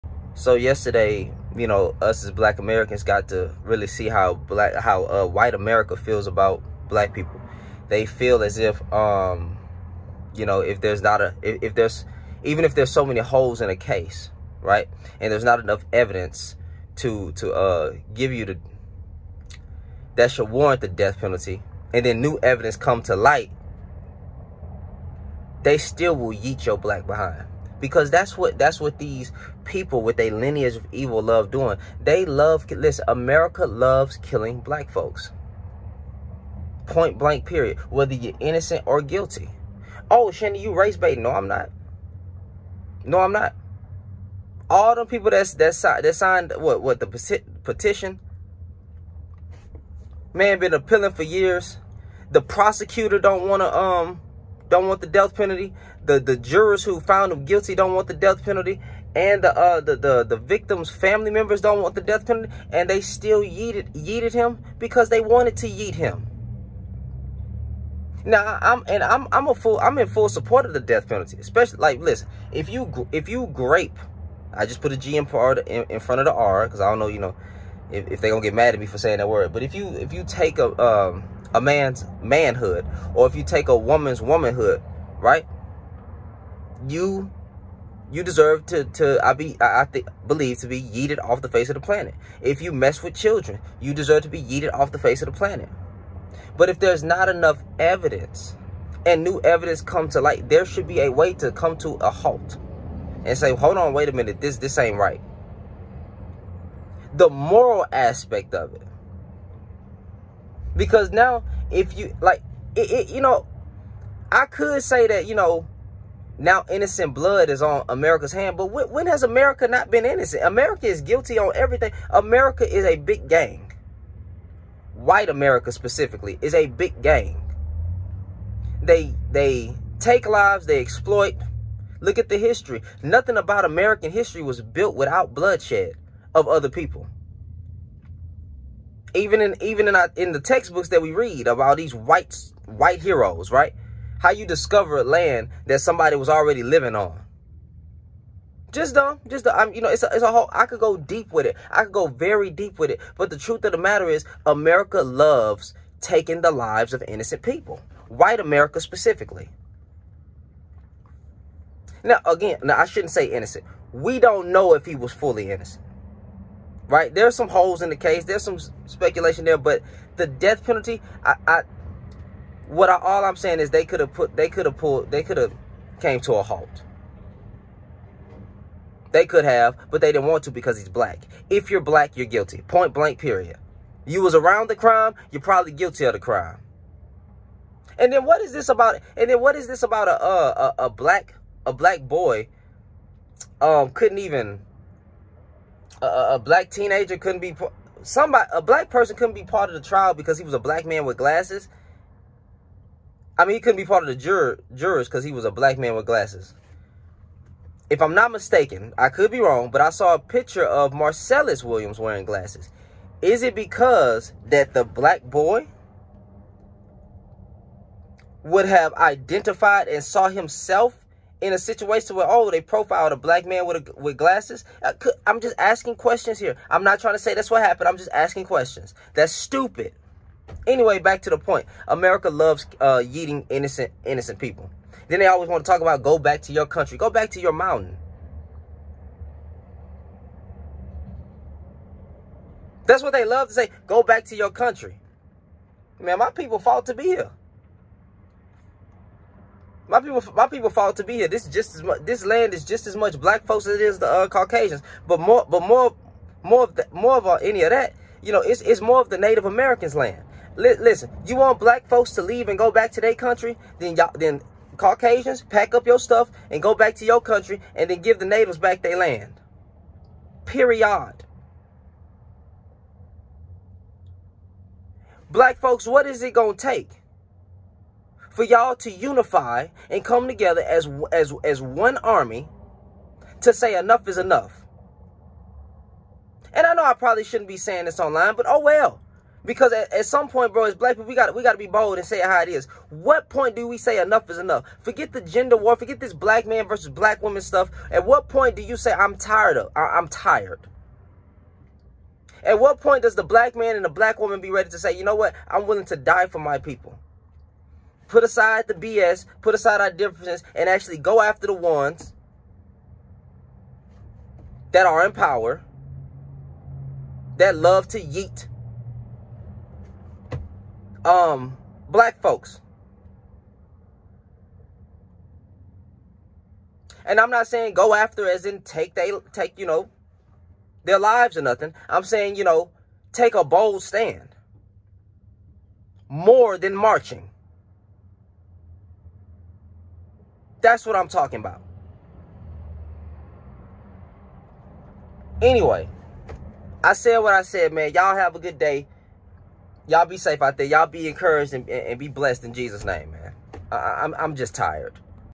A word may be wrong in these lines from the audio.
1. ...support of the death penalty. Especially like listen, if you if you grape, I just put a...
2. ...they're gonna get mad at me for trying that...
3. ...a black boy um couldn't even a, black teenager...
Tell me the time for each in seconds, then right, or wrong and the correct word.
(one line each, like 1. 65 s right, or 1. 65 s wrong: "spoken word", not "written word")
1. 70 s right
2. 78 s wrong: "saying", not "trying"
3. 191 s right.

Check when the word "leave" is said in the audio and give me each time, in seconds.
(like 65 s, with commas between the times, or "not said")
262 s.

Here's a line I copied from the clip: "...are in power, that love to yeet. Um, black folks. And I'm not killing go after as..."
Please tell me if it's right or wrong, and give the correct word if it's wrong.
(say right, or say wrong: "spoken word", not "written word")
wrong: "saying", not "killing".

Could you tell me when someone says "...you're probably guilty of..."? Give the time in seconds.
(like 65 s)
185 s.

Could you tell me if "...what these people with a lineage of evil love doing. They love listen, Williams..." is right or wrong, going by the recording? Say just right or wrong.
wrong.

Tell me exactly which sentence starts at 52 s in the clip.
The prosecutor don't wanna um don't want the death penalty.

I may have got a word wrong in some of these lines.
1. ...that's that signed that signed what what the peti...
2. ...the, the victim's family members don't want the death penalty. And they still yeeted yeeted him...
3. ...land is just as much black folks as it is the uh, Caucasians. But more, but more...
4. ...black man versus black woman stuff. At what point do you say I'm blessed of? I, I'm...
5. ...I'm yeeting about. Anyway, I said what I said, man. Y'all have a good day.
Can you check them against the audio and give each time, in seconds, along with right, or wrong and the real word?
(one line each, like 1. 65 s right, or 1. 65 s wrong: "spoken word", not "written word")
1. 45 s right
2. 59 s right
3. 252 s right
4. 296 s wrong: "tired", not "blessed"
5. 340 s wrong: "talking", not "yeeting".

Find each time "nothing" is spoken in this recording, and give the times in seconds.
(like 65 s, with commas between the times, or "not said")
133 s, 331 s.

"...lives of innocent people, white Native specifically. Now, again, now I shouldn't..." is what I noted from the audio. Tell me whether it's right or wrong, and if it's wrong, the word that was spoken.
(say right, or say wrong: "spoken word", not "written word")
wrong: "America", not "Native".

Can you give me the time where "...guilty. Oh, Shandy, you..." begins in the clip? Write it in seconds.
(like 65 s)
39 s.